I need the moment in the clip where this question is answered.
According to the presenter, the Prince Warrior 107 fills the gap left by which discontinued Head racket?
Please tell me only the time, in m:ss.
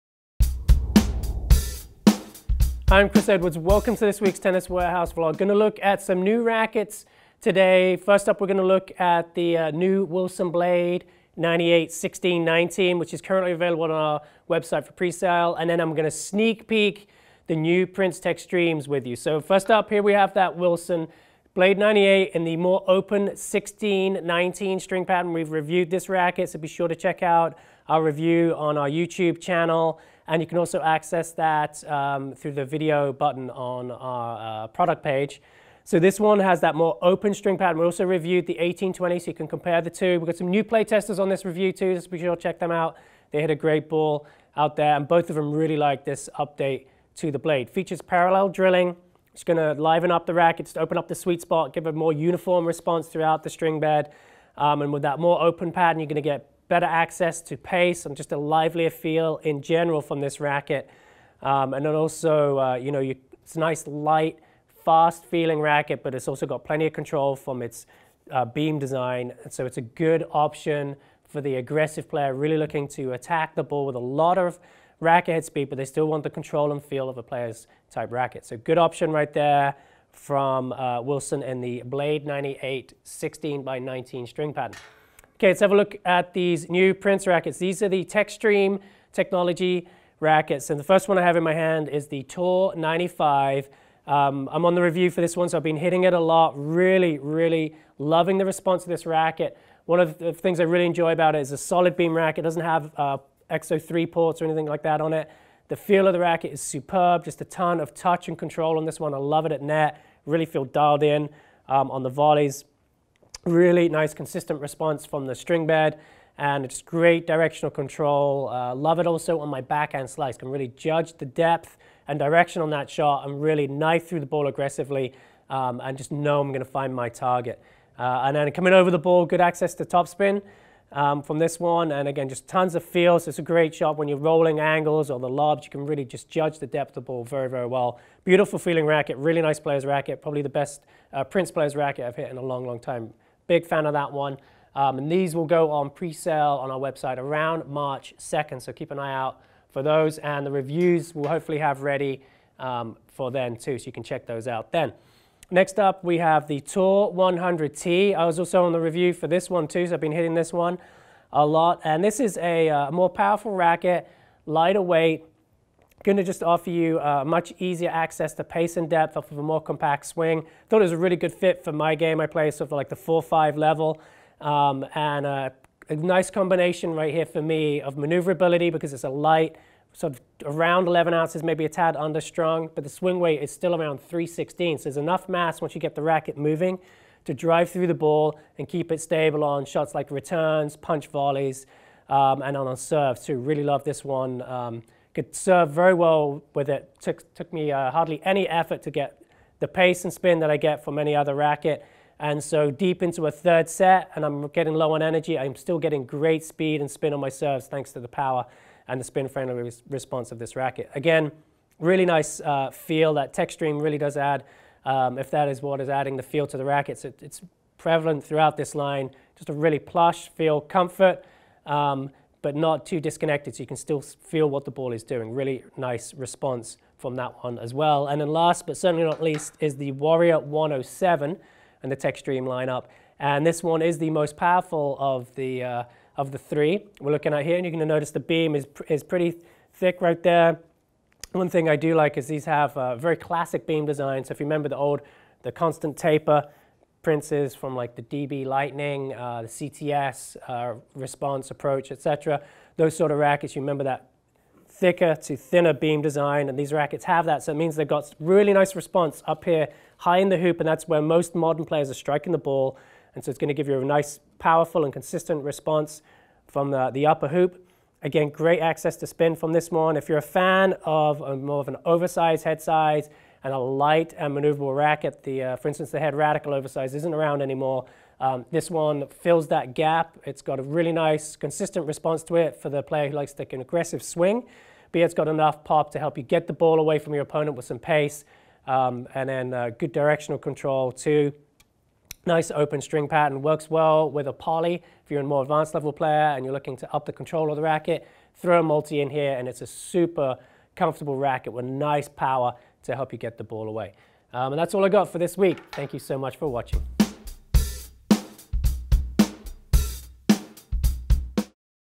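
4:35.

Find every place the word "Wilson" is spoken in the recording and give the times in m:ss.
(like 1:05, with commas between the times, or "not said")
0:10, 0:20, 1:21.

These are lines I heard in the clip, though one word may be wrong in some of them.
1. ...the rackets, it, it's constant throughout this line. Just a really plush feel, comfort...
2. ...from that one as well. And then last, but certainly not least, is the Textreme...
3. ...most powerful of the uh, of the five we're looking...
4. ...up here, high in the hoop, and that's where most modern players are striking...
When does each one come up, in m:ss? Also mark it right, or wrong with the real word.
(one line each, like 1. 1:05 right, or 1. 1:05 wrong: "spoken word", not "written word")
1. 3:36 wrong: "prevalent", not "constant"
2. 3:46 wrong: "Warrior", not "Textreme"
3. 3:54 wrong: "three", not "five"
4. 4:19 right.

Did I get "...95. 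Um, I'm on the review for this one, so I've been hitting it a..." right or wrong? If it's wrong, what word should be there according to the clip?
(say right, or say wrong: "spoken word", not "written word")
right.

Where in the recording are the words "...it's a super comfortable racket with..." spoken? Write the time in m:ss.
4:59.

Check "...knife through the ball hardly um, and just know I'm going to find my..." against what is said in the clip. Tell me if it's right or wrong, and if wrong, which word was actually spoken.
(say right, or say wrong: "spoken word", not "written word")
wrong: "aggressively", not "hardly".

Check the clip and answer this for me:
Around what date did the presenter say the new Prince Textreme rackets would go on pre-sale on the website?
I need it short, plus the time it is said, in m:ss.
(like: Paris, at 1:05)
March 2nd, at 2:27.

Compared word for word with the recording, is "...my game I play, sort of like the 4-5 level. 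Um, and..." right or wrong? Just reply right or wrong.
right.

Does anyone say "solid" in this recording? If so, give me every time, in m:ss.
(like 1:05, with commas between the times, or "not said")
1:41.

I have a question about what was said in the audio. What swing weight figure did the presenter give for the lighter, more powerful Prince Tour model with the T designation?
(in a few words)
316.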